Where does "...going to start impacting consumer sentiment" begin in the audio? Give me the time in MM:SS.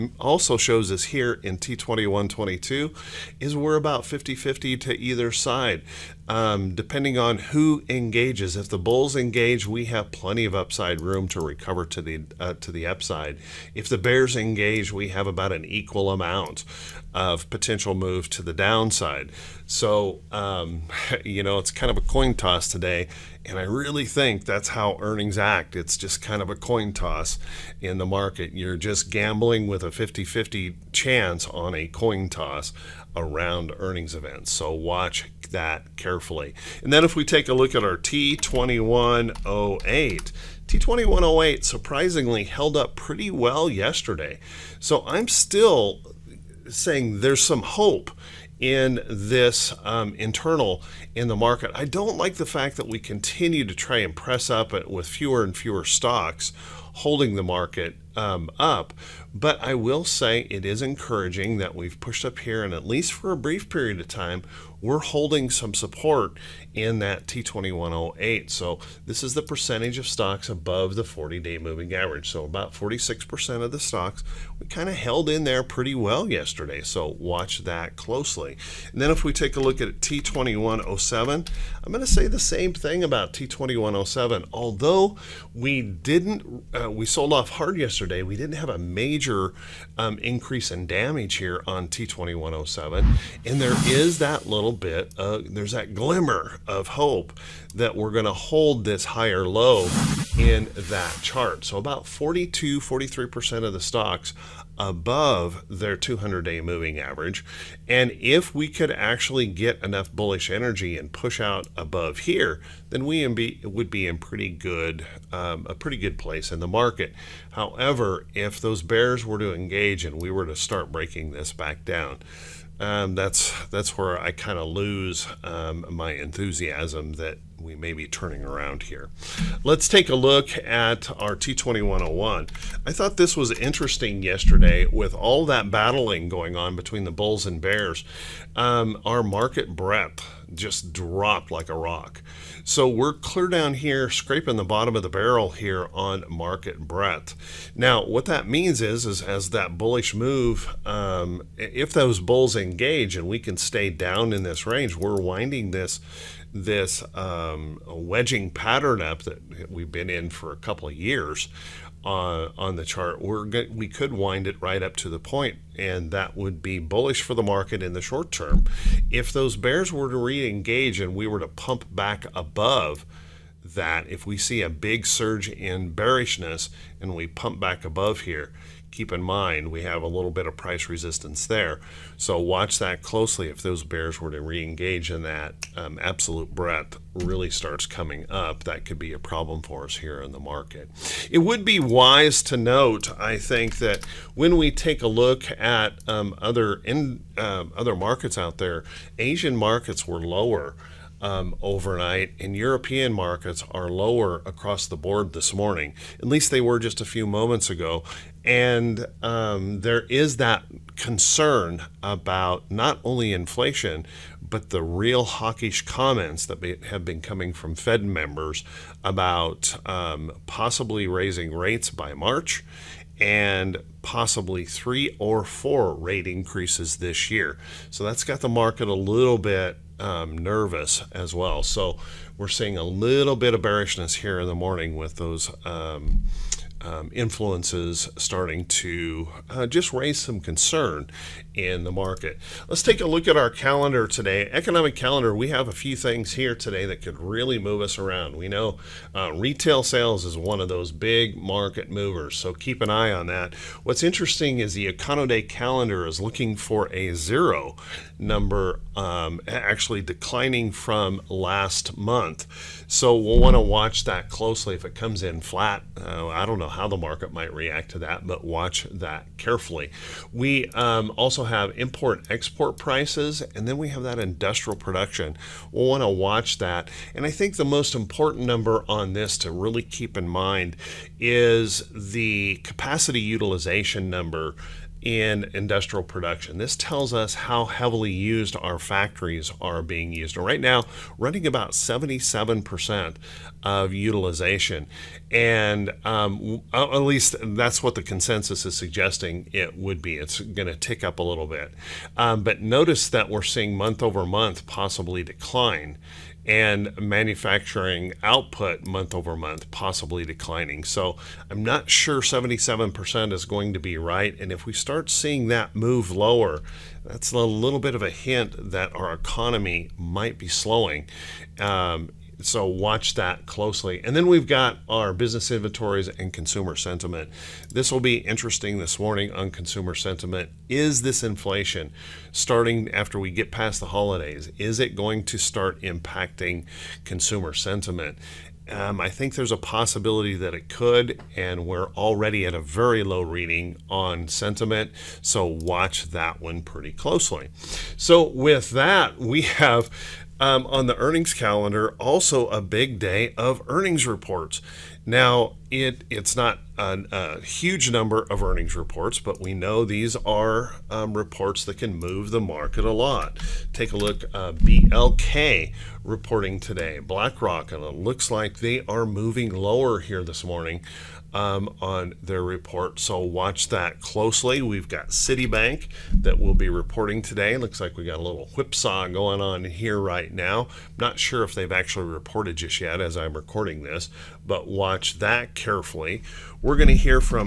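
05:34.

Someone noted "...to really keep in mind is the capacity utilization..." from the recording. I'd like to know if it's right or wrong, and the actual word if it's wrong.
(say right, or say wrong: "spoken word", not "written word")
right.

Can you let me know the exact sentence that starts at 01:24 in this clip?
Although we didn't, uh, we sold off hard yesterday.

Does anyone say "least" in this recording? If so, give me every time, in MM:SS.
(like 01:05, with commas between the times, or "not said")
01:02, 03:26, 04:57.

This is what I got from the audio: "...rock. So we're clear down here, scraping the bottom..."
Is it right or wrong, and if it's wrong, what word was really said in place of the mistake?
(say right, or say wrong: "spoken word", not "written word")
right.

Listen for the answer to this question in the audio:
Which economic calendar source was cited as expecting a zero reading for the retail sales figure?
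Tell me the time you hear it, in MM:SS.
04:14.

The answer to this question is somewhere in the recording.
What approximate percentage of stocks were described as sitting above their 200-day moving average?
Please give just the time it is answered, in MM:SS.
01:42.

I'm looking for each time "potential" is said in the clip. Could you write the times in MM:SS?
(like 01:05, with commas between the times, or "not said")
00:17.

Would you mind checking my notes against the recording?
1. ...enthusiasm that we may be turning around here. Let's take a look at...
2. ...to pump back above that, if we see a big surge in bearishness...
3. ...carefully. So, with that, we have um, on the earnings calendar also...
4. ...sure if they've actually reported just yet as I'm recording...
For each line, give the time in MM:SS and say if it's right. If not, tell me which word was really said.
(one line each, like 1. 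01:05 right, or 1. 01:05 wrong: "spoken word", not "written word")
1. 02:06 right
2. 02:51 right
3. 05:46 wrong: "closely", not "carefully"
4. 06:21 right.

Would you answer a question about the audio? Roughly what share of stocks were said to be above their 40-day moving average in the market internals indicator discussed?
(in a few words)
46%.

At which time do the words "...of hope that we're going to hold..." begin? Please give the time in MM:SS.
01:36.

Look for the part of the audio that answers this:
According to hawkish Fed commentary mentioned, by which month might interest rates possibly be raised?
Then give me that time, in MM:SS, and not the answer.
03:42.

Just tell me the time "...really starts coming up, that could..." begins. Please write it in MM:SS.
03:07.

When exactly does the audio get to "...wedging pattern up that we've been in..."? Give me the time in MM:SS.
02:37.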